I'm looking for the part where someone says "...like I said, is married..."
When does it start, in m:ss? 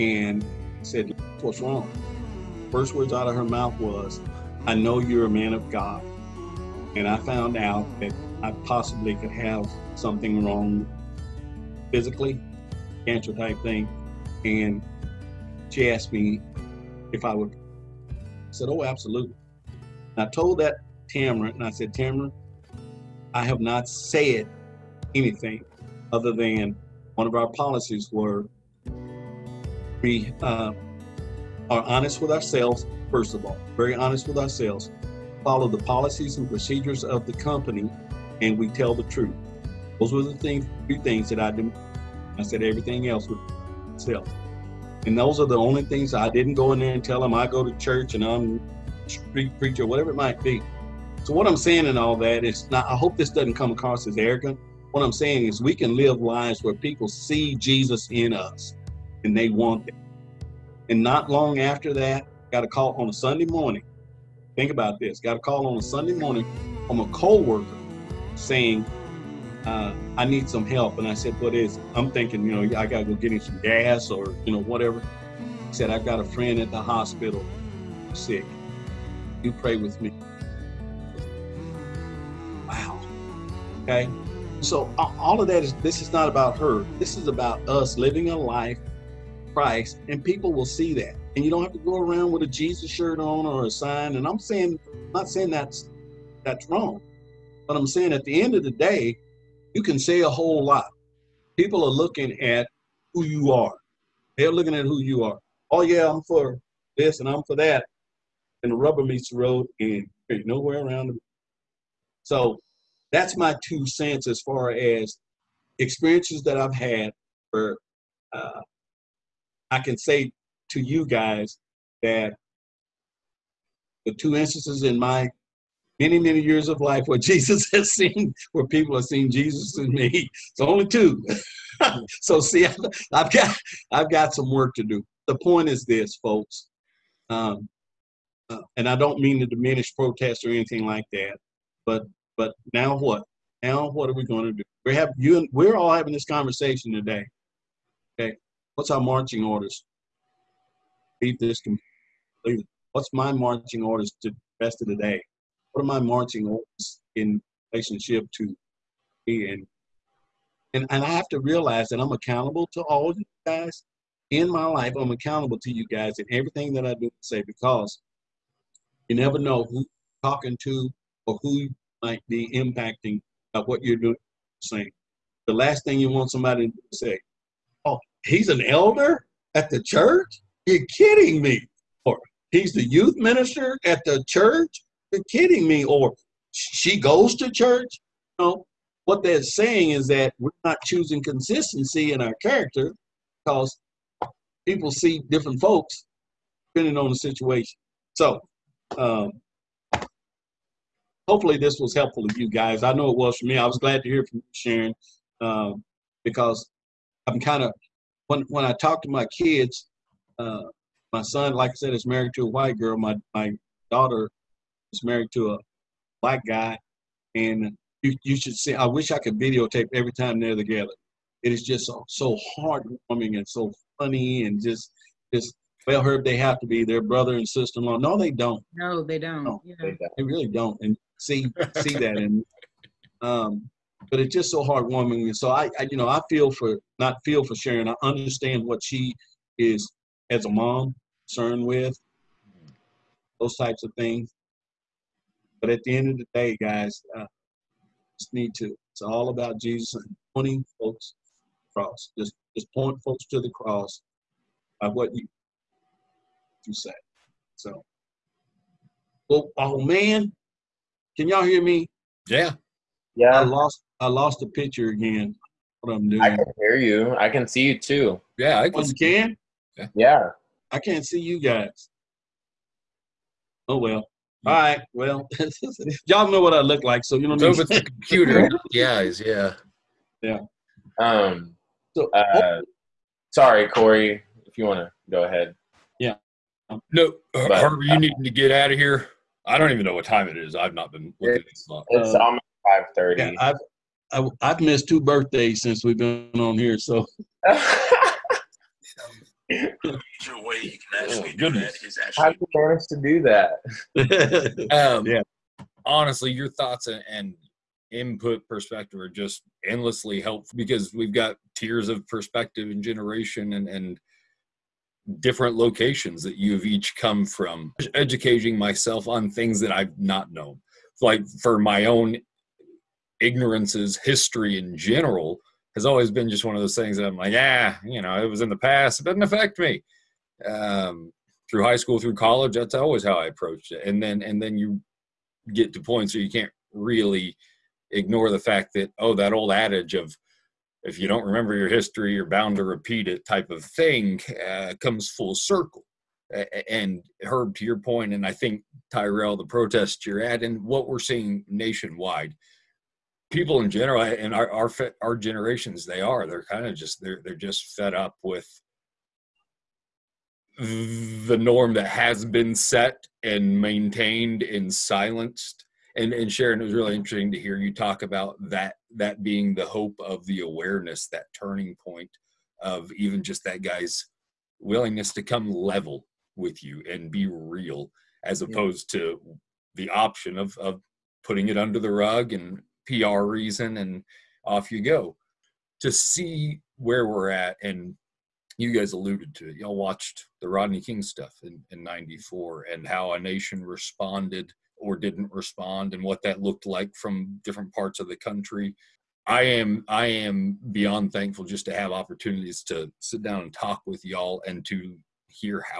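3:31.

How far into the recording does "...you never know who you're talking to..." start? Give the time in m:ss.
2:49.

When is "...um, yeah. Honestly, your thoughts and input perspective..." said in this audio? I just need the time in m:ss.
5:04.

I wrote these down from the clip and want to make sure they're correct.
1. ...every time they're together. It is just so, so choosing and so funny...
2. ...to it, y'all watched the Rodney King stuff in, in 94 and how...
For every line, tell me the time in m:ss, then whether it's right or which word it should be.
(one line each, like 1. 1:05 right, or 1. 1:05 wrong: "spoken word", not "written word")
1. 3:39 wrong: "heartwarming", not "choosing"
2. 6:29 right.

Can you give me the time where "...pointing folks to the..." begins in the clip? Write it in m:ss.
4:10.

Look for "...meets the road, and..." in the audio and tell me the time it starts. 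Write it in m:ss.
1:49.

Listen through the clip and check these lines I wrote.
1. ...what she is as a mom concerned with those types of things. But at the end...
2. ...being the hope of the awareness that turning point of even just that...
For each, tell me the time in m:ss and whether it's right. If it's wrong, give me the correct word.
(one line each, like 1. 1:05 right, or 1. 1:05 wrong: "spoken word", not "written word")
1. 3:58 right
2. 6:09 right.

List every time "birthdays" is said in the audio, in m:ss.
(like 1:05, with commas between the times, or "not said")
4:55.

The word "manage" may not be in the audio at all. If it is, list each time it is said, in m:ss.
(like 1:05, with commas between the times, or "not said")
5:02.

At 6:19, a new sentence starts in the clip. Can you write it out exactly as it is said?
to the option of of putting it under the rug and PR reason, and off you go.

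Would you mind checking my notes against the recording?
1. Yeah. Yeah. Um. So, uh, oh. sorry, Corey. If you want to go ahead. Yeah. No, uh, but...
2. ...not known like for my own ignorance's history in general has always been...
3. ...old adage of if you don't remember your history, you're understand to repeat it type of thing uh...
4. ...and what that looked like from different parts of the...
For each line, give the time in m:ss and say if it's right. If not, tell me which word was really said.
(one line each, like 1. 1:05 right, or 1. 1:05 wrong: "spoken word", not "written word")
1. 4:39 right
2. 5:19 right
3. 5:39 wrong: "bound", not "understand"
4. 6:35 right.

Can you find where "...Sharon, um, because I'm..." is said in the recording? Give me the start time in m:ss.
3:24.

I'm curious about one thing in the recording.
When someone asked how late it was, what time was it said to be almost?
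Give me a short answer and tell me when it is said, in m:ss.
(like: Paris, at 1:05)
5:30, at 4:52.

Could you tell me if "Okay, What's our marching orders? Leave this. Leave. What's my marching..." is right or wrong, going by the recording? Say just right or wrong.
right.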